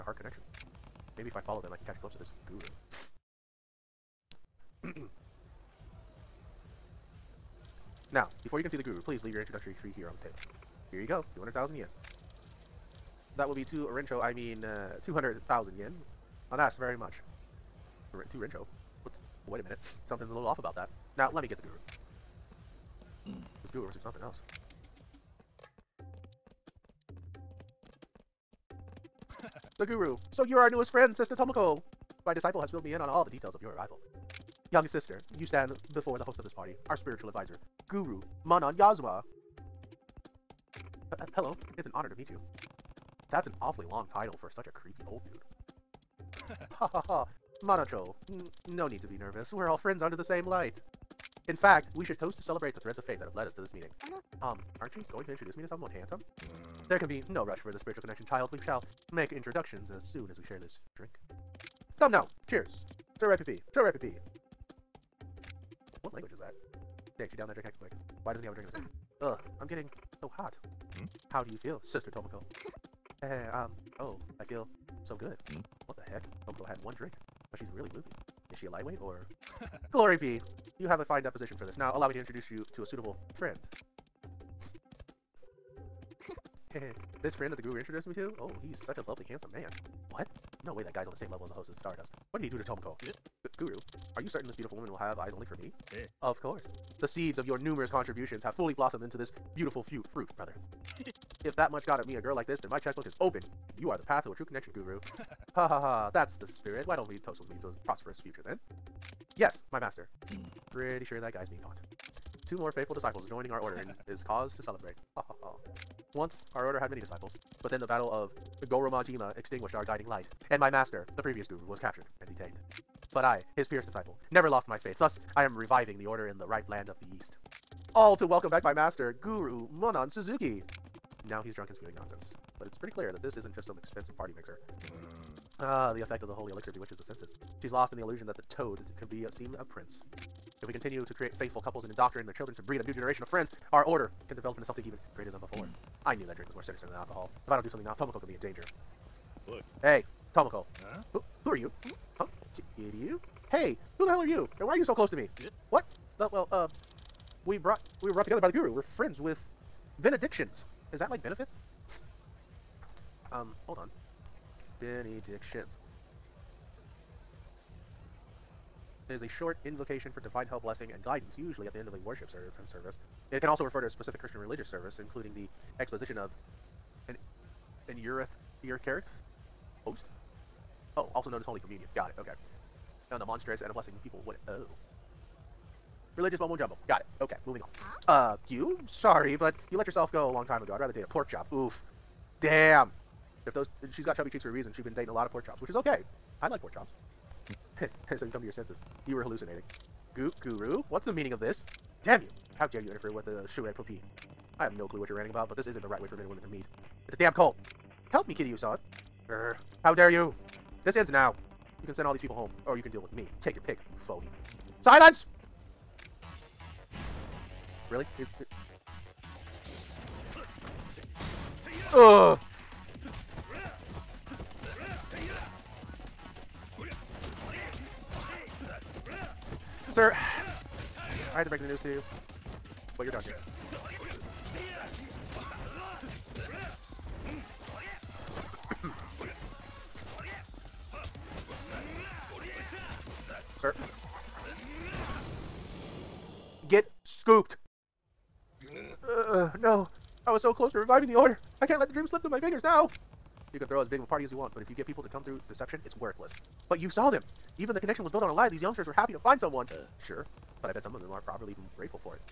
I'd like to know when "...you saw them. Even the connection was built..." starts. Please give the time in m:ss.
4:16.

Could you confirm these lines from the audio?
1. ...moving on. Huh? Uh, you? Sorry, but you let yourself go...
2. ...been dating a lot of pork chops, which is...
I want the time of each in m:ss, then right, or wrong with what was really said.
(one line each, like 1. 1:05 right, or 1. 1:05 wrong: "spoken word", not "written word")
1. 3:07 right
2. 3:14 right.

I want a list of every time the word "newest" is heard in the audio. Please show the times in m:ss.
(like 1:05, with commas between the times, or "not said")
0:30.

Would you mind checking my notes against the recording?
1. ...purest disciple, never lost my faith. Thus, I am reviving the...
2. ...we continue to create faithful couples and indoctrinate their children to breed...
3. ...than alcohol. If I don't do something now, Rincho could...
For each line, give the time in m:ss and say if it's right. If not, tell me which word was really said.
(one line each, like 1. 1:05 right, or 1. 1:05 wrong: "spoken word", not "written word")
1. 2:03 right
2. 2:20 right
3. 2:26 wrong: "Tomoko", not "Rincho".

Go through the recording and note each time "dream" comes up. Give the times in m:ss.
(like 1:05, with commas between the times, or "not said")
4:11.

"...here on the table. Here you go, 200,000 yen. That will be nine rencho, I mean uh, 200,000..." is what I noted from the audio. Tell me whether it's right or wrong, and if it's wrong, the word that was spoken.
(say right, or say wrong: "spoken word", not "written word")
wrong: "two", not "nine".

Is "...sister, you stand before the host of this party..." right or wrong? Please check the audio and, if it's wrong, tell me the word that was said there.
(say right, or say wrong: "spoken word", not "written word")
right.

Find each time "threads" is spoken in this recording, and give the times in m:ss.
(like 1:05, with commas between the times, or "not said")
0:52.